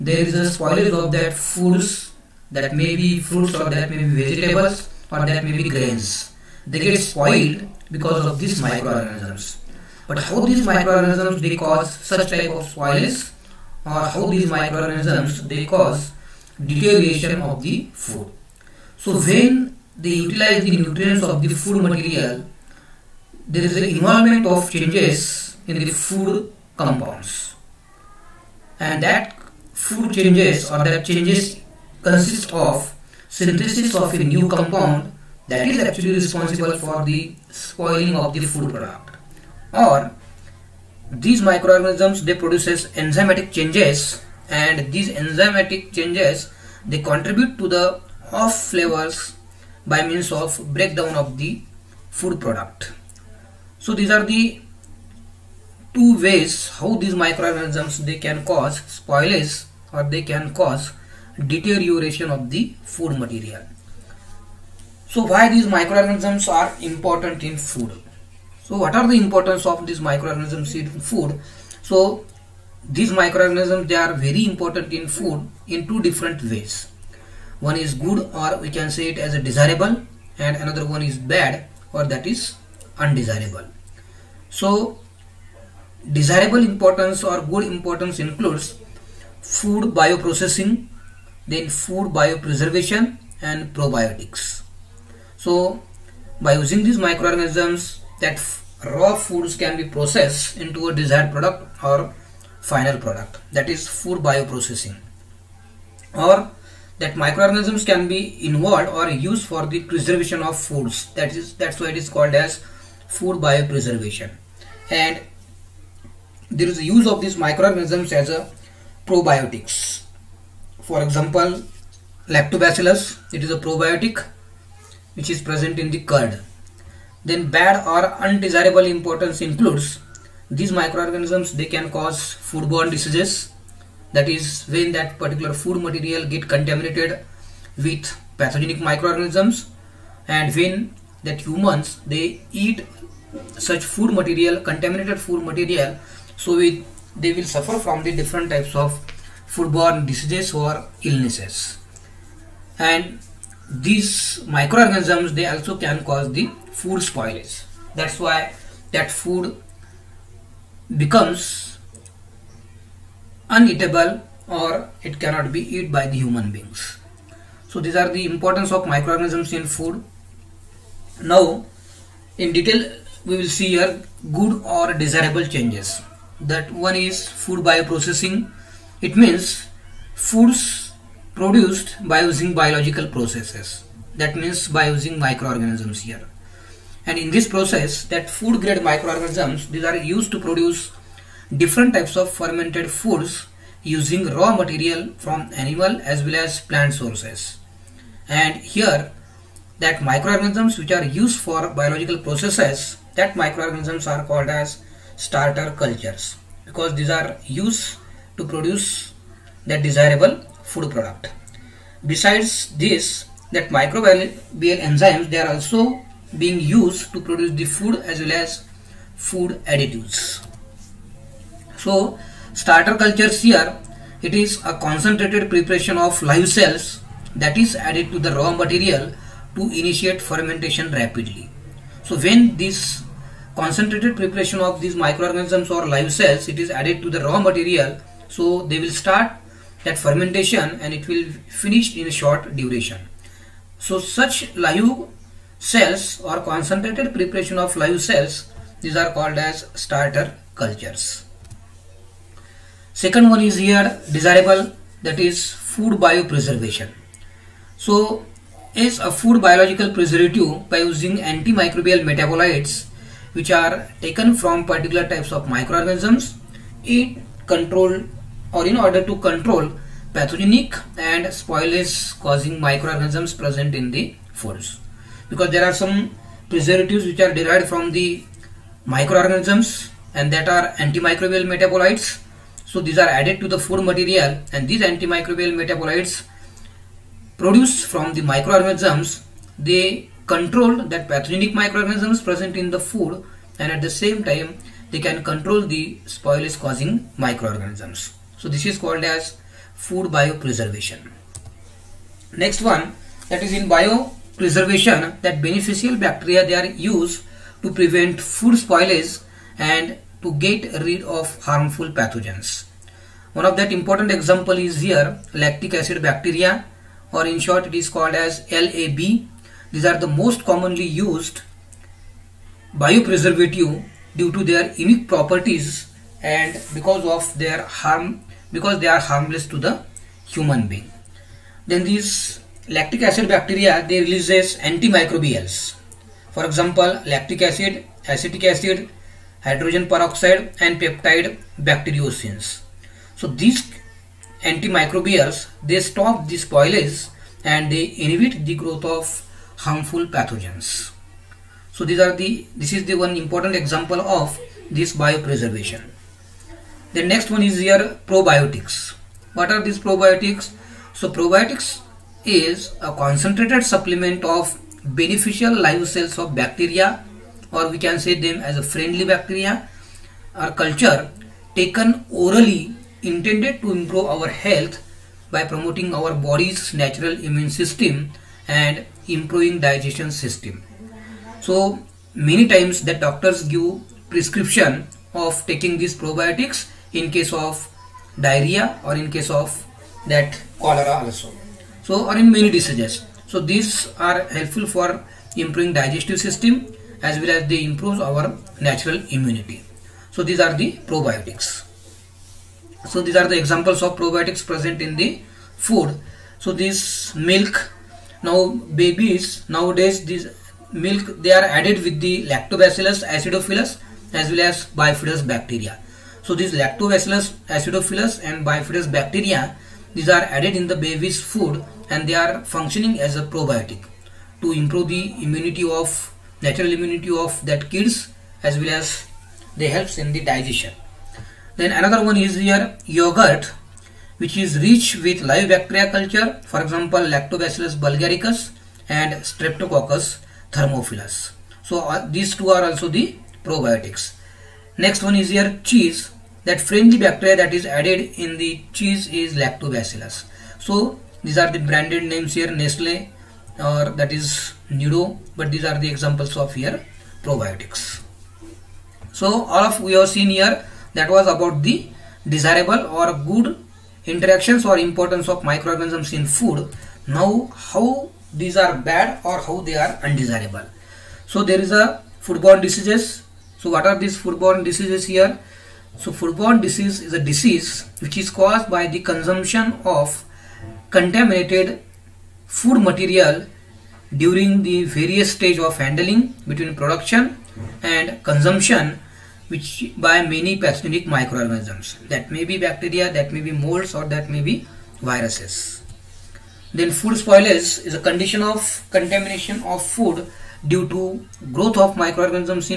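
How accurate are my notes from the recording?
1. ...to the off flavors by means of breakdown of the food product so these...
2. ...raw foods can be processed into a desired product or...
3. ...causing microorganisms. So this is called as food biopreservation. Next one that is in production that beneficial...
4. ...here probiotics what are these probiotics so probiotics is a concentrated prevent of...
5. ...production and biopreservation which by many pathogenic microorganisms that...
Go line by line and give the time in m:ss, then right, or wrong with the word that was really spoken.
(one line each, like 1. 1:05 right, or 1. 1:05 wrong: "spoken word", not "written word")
1. 0:47 right
2. 1:38 right
3. 4:56 wrong: "biopreservation", not "production"
4. 5:57 wrong: "supplement", not "prevent"
5. 8:06 wrong: "consumption", not "biopreservation".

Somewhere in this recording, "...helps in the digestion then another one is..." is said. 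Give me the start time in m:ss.
7:09.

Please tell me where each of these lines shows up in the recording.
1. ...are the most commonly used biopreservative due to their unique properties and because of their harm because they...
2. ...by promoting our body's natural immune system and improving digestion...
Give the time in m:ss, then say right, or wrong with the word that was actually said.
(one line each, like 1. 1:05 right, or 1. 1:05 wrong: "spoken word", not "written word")
1. 5:19 right
2. 6:15 right.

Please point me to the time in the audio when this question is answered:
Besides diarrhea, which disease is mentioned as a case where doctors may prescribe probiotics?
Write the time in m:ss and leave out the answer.
6:30.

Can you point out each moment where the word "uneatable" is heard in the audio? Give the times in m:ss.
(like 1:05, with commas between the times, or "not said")
2:43.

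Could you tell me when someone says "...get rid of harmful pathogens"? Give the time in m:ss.
5:10.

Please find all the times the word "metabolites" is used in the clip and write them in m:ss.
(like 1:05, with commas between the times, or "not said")
4:22, 4:41, 4:45.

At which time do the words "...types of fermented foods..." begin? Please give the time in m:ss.
3:11.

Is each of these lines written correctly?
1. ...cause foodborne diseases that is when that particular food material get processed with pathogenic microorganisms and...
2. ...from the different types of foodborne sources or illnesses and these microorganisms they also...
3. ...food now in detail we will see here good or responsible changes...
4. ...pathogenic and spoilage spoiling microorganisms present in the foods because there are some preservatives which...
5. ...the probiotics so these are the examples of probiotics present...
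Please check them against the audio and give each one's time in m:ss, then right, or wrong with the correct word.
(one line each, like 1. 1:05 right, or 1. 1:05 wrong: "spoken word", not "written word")
1. 2:11 wrong: "contaminated", not "processed"
2. 2:27 wrong: "diseases", not "sources"
3. 2:49 wrong: "desirable", not "responsible"
4. 4:30 wrong: "causing", not "spoiling"
5. 6:40 right.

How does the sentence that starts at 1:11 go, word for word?
So these microorganisms they are very important in food in two different ways.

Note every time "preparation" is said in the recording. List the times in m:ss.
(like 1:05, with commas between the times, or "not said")
3:45, 3:54, 4:07.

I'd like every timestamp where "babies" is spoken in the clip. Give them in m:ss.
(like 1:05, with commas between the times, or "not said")
6:48.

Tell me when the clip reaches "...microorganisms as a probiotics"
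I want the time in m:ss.
1:57.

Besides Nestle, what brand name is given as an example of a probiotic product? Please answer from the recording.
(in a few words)
Nido.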